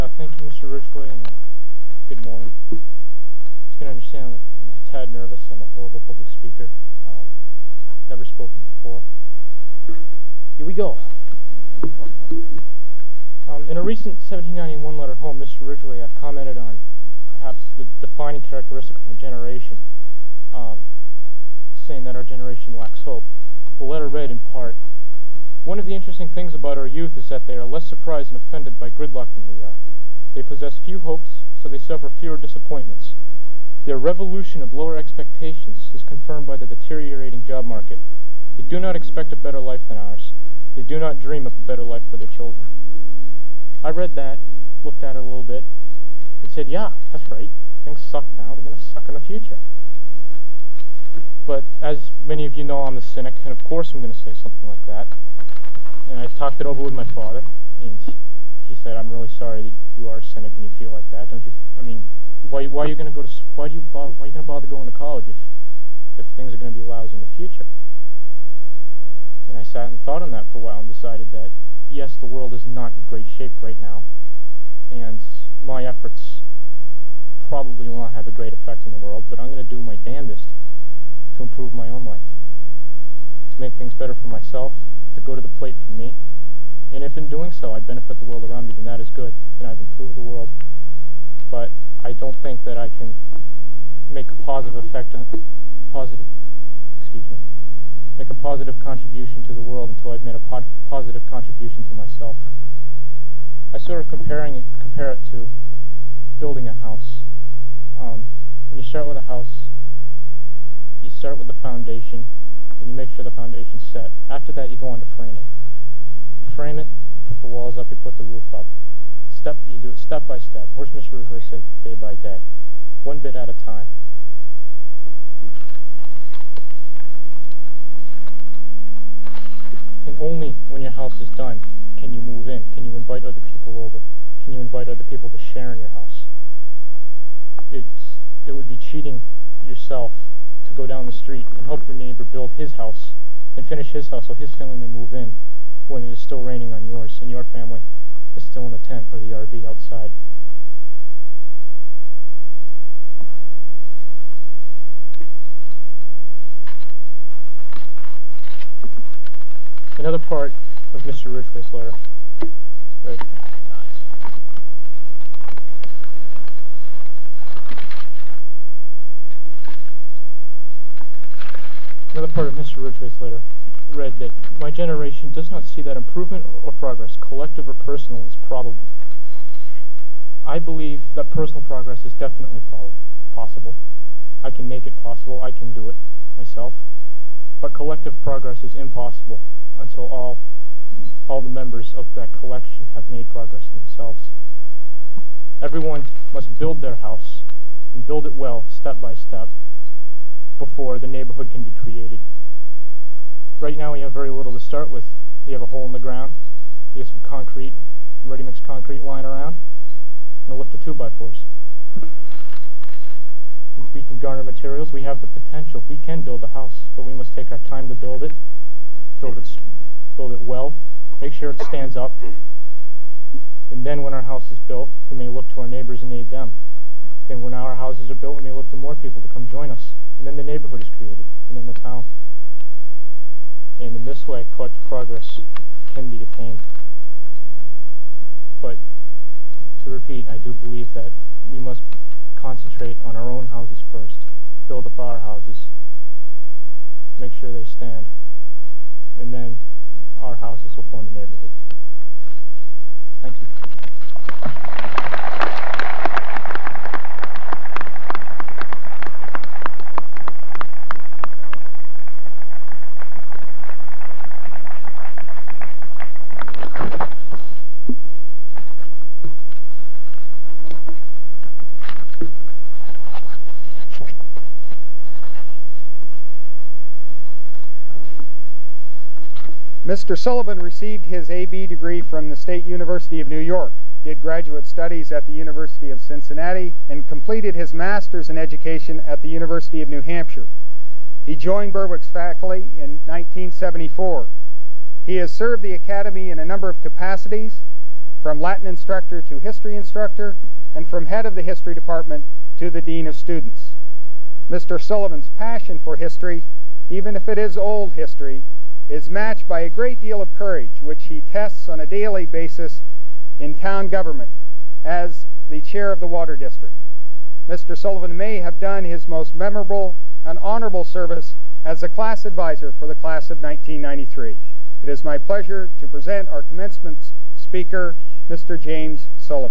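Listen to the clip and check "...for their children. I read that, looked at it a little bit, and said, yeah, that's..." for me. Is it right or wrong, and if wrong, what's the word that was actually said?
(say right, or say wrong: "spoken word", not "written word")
right.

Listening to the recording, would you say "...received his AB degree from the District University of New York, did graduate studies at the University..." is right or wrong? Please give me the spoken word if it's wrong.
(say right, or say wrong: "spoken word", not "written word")
wrong: "State", not "District".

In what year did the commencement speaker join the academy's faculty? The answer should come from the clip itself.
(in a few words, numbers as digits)
1974.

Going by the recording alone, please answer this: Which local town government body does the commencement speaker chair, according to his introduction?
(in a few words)
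Water District.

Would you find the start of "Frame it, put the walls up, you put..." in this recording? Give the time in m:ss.
1:56.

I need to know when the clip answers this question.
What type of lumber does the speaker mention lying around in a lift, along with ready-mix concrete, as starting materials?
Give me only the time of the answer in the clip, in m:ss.
3:30.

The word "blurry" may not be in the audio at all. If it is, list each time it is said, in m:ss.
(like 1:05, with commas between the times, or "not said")
not said.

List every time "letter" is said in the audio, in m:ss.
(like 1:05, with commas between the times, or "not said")
0:14, 0:23, 2:41, 2:53.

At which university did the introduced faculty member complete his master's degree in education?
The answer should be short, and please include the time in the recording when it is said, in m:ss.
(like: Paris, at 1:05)
University of New Hampshire, at 4:49.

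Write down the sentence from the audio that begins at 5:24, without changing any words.
It is my pleasure to present our commencement speaker, Mr.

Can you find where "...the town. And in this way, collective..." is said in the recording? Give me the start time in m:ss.
3:51.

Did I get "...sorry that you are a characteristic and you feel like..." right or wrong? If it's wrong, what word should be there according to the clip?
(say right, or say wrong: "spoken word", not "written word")
wrong: "cynic", not "characteristic".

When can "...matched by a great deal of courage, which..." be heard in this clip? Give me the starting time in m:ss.
5:09.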